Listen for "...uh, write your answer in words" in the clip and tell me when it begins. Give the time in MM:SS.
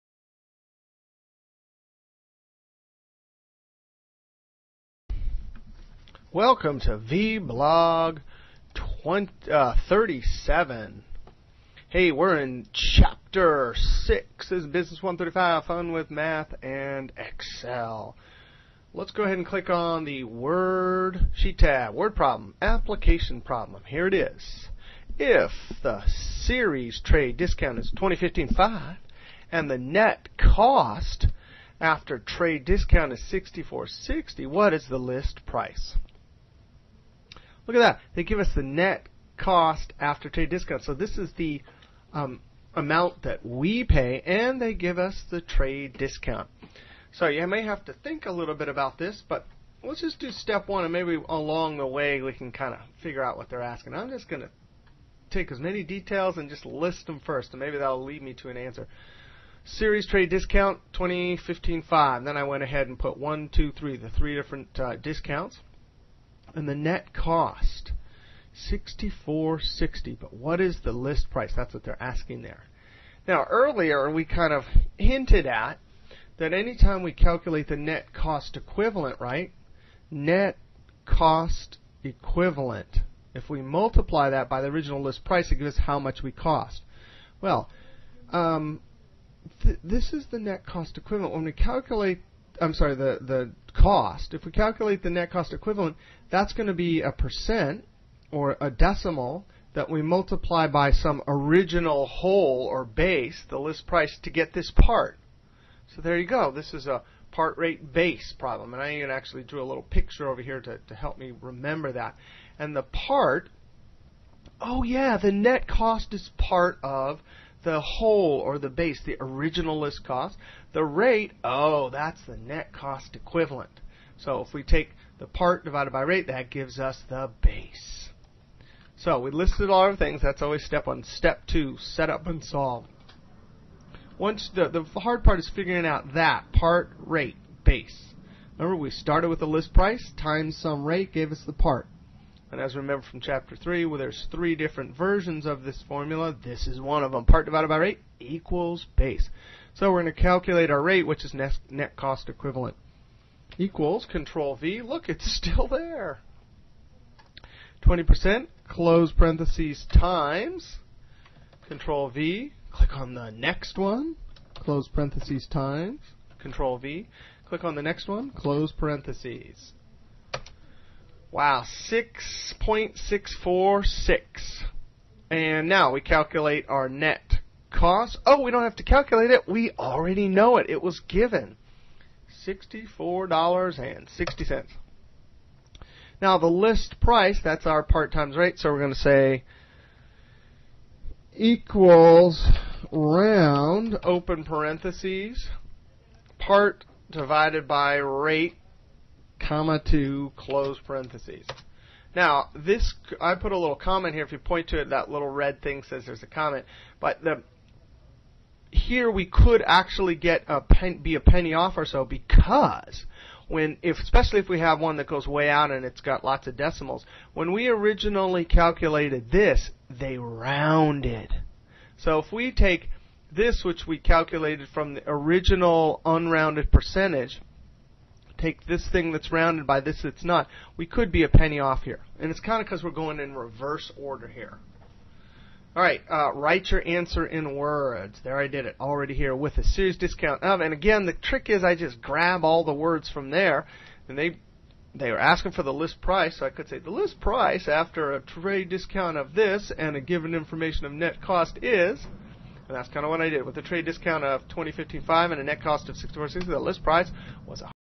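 03:56.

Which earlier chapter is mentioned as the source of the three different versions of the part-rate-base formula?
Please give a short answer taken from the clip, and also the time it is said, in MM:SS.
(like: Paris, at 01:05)
Chapter 3, at 02:23.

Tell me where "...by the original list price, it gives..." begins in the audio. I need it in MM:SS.
01:24.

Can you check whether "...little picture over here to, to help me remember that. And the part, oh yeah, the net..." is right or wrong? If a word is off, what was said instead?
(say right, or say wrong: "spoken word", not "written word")
right.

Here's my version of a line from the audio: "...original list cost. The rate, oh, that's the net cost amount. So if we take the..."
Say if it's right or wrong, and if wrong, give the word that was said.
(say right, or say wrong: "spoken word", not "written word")
wrong: "equivalent", not "amount".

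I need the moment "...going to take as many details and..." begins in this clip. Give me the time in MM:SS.
00:54.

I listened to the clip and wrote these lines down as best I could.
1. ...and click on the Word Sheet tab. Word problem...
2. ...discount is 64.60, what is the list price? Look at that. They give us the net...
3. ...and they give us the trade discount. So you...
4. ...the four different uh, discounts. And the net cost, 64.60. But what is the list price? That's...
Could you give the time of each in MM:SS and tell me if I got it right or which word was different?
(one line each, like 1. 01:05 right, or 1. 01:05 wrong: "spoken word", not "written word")
1. 00:19 right
2. 00:32 right
3. 00:44 right
4. 01:03 wrong: "three", not "four".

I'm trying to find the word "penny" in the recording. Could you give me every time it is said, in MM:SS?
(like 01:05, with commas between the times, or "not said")
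03:31, 03:51.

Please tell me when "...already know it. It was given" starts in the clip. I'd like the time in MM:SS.
02:59.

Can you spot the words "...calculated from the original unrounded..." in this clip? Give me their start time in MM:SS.
03:43.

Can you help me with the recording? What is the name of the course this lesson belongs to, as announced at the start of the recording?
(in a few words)
Business 135 Fun with Math and Excel.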